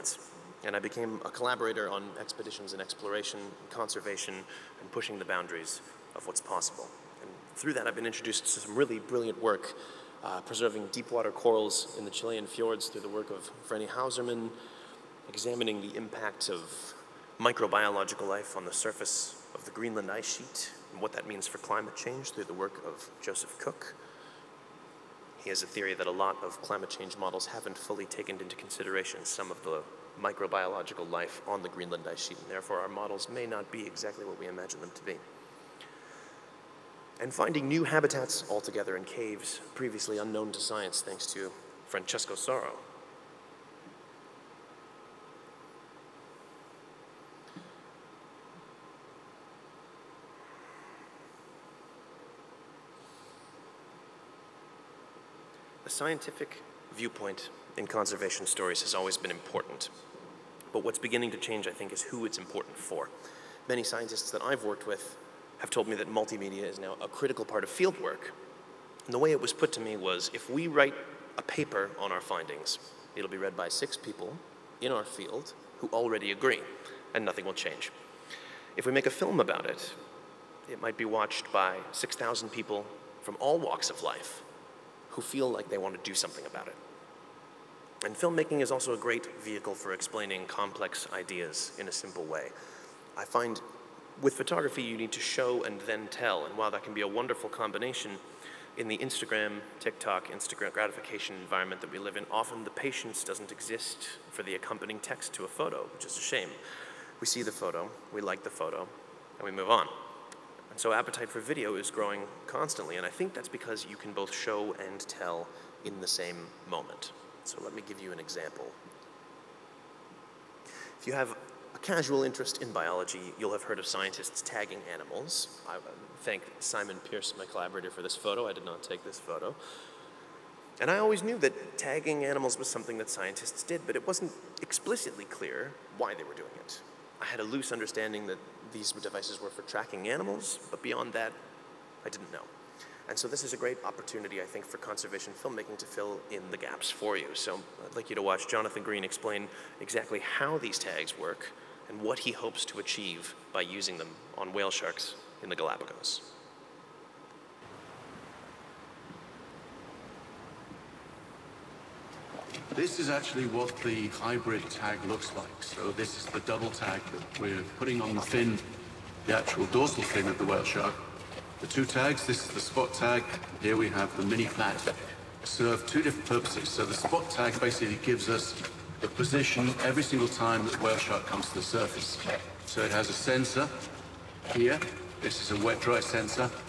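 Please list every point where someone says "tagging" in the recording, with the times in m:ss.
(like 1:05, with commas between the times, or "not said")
2:04, 2:11.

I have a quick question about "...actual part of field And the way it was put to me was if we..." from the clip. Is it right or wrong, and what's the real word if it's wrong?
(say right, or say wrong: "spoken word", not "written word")
wrong: "critical", not "actual".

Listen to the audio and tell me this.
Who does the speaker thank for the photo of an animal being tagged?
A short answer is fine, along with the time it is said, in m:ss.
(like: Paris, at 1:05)
Simon Pierce, at 2:06.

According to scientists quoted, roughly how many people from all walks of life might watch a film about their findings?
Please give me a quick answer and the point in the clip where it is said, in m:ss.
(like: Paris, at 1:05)
6,000, at 1:21.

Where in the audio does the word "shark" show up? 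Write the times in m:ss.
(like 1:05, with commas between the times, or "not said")
2:34, 2:50, 3:00.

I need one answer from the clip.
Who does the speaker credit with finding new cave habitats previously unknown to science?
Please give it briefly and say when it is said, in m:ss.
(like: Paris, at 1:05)
Francesco Sauro, at 0:41.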